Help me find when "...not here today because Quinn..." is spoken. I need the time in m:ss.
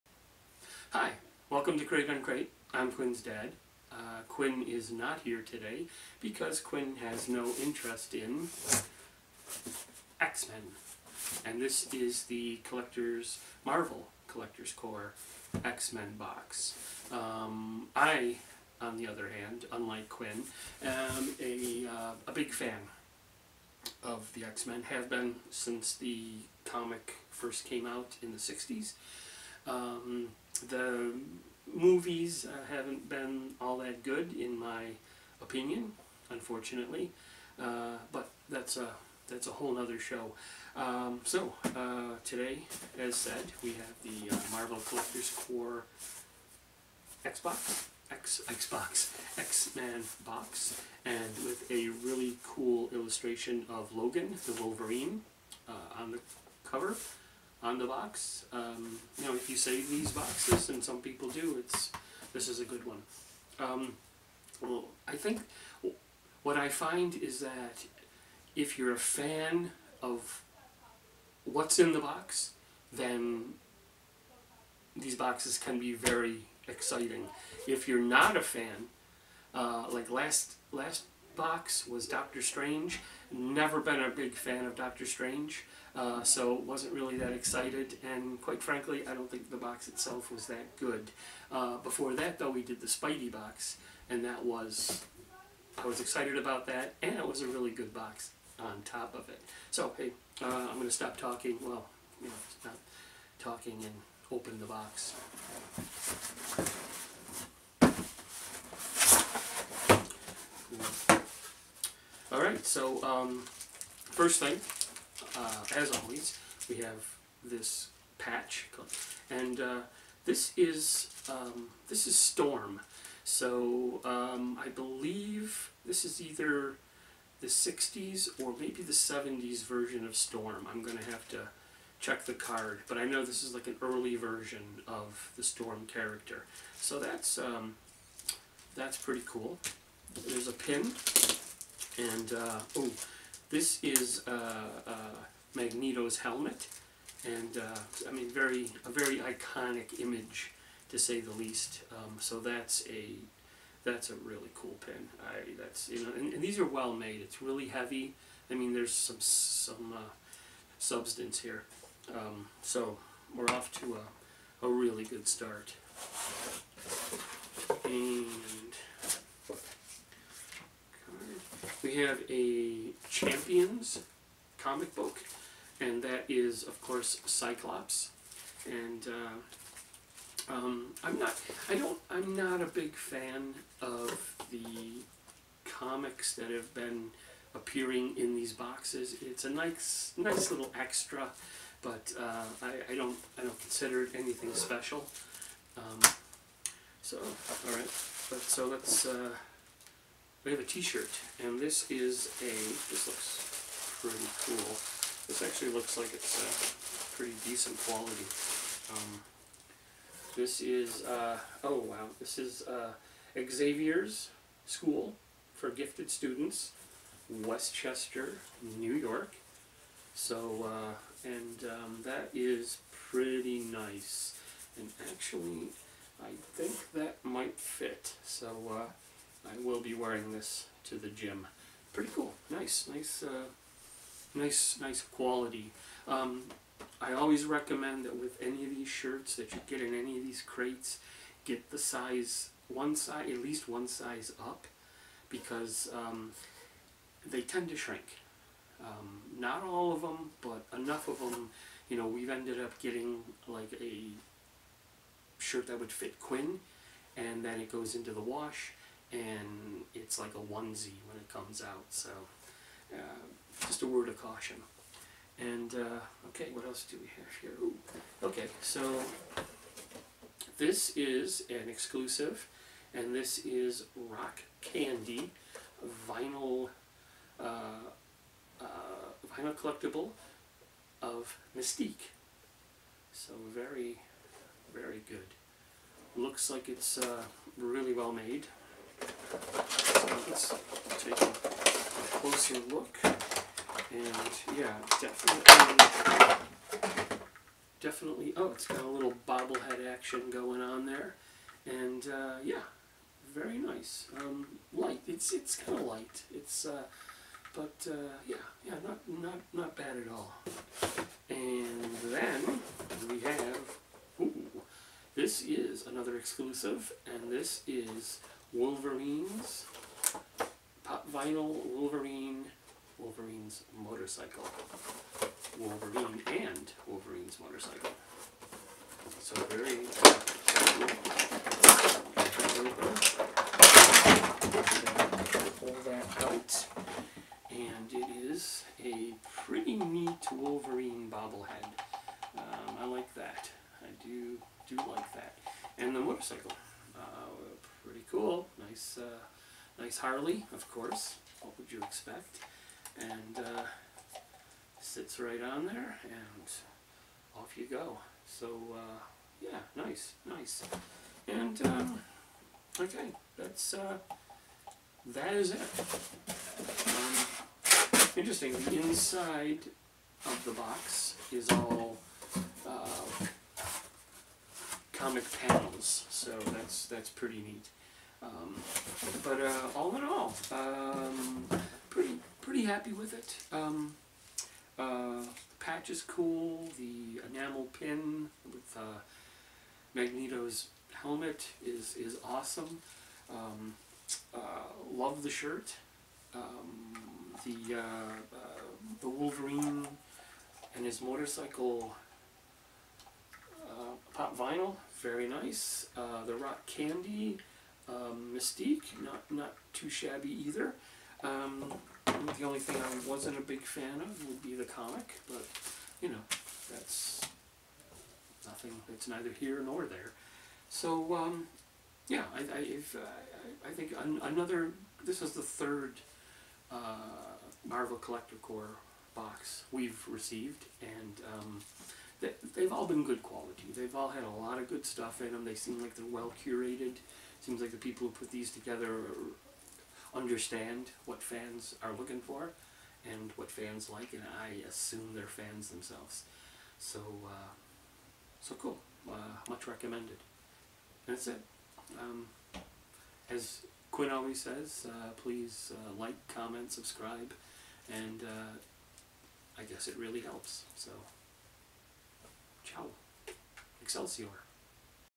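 0:04.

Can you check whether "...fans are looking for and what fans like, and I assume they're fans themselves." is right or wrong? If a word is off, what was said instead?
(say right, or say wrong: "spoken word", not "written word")
right.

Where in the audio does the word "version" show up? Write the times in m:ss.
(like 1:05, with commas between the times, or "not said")
2:09, 2:14.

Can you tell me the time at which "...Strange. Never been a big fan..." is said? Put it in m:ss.
1:22.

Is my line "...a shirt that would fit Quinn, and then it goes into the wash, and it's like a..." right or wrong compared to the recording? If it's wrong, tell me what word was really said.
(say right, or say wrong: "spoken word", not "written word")
right.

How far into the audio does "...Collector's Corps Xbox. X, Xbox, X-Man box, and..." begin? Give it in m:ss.
0:44.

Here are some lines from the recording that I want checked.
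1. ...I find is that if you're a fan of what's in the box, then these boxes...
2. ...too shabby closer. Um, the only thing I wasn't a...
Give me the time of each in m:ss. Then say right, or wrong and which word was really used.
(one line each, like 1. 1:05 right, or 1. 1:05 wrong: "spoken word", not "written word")
1. 1:06 right
2. 6:49 wrong: "either", not "closer".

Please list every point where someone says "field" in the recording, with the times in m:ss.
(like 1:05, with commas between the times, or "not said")
not said.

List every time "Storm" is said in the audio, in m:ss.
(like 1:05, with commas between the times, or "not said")
2:02, 2:10, 2:15.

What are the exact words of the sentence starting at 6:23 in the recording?
Um, uh, the patch is cool.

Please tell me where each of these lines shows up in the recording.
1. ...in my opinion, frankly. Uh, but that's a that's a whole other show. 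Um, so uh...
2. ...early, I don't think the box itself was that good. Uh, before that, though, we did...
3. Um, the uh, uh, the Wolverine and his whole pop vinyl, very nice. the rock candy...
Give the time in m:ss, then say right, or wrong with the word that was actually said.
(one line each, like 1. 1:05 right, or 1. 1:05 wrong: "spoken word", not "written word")
1. 0:34 wrong: "unfortunately", not "frankly"
2. 1:28 wrong: "frankly", not "early"
3. 6:36 wrong: "motorcycle", not "whole".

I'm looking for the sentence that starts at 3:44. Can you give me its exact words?
And actually, I think that might fit.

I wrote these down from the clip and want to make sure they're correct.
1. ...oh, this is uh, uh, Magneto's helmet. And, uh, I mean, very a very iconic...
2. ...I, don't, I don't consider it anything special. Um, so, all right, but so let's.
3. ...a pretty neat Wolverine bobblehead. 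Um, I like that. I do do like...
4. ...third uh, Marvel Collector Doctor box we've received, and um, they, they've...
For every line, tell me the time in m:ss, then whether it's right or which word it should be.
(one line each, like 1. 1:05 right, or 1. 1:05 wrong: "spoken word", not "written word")
1. 2:22 right
2. 3:12 right
3. 5:38 right
4. 7:05 wrong: "Corps", not "Doctor".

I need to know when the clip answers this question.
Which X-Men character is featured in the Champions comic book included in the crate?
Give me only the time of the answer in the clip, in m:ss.
2:57.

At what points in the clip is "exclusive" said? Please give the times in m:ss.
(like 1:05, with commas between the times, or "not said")
4:31, 5:16.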